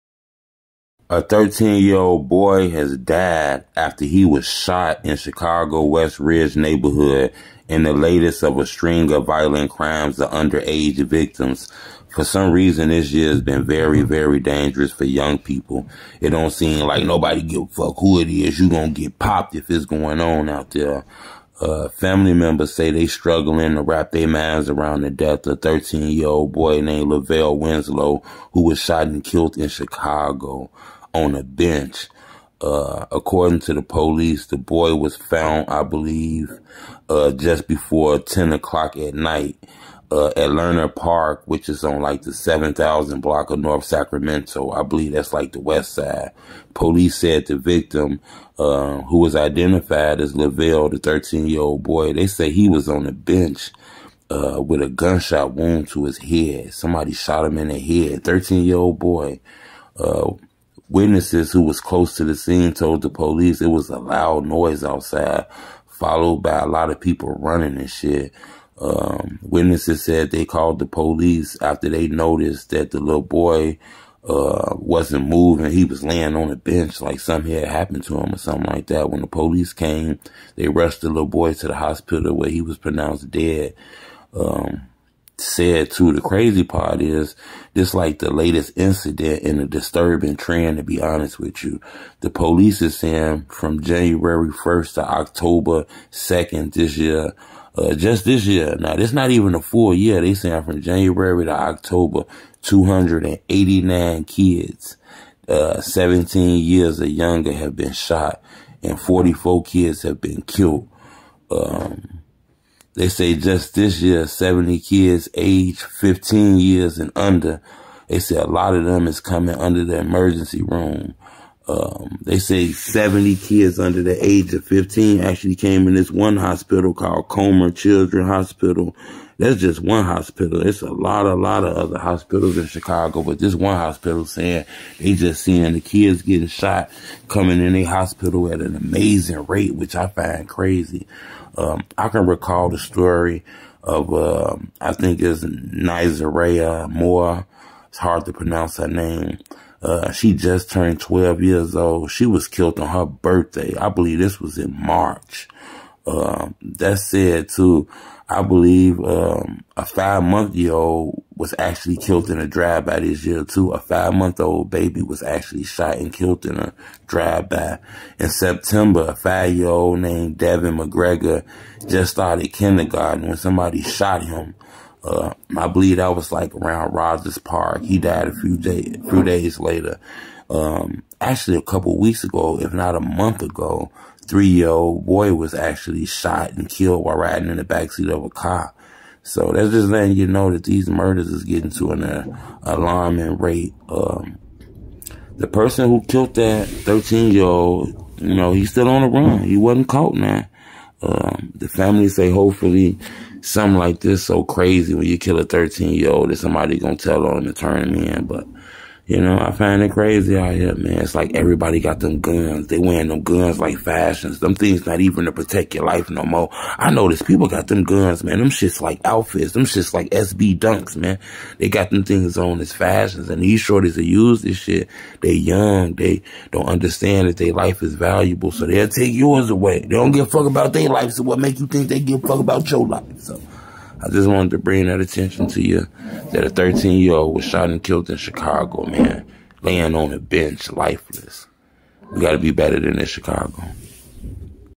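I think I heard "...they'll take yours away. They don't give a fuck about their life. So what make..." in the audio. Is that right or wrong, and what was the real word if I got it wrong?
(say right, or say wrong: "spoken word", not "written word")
right.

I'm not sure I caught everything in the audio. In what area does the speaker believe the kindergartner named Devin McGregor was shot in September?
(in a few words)
Rogers Park.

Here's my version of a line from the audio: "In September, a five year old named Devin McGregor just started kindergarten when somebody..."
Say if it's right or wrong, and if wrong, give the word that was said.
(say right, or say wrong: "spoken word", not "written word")
right.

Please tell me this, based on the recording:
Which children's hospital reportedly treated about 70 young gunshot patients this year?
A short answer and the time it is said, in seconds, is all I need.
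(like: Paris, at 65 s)
Comer Children's Hospital, at 127 s.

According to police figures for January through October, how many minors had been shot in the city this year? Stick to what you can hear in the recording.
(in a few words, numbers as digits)
289.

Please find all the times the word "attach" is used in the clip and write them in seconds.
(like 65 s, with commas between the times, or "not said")
not said.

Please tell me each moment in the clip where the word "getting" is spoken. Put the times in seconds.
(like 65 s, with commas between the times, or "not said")
136 s, 191 s.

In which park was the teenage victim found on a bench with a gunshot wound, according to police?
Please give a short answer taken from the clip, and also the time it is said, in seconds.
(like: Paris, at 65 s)
Lerner Park, at 40 s.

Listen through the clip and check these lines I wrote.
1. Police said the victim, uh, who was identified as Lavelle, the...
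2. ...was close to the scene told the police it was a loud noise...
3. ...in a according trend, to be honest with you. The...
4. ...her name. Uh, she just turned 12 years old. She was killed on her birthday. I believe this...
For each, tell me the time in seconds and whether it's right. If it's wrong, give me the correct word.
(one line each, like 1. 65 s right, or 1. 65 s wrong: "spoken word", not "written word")
1. 46 s right
2. 61 s right
3. 89 s wrong: "disturbing", not "according"
4. 148 s right.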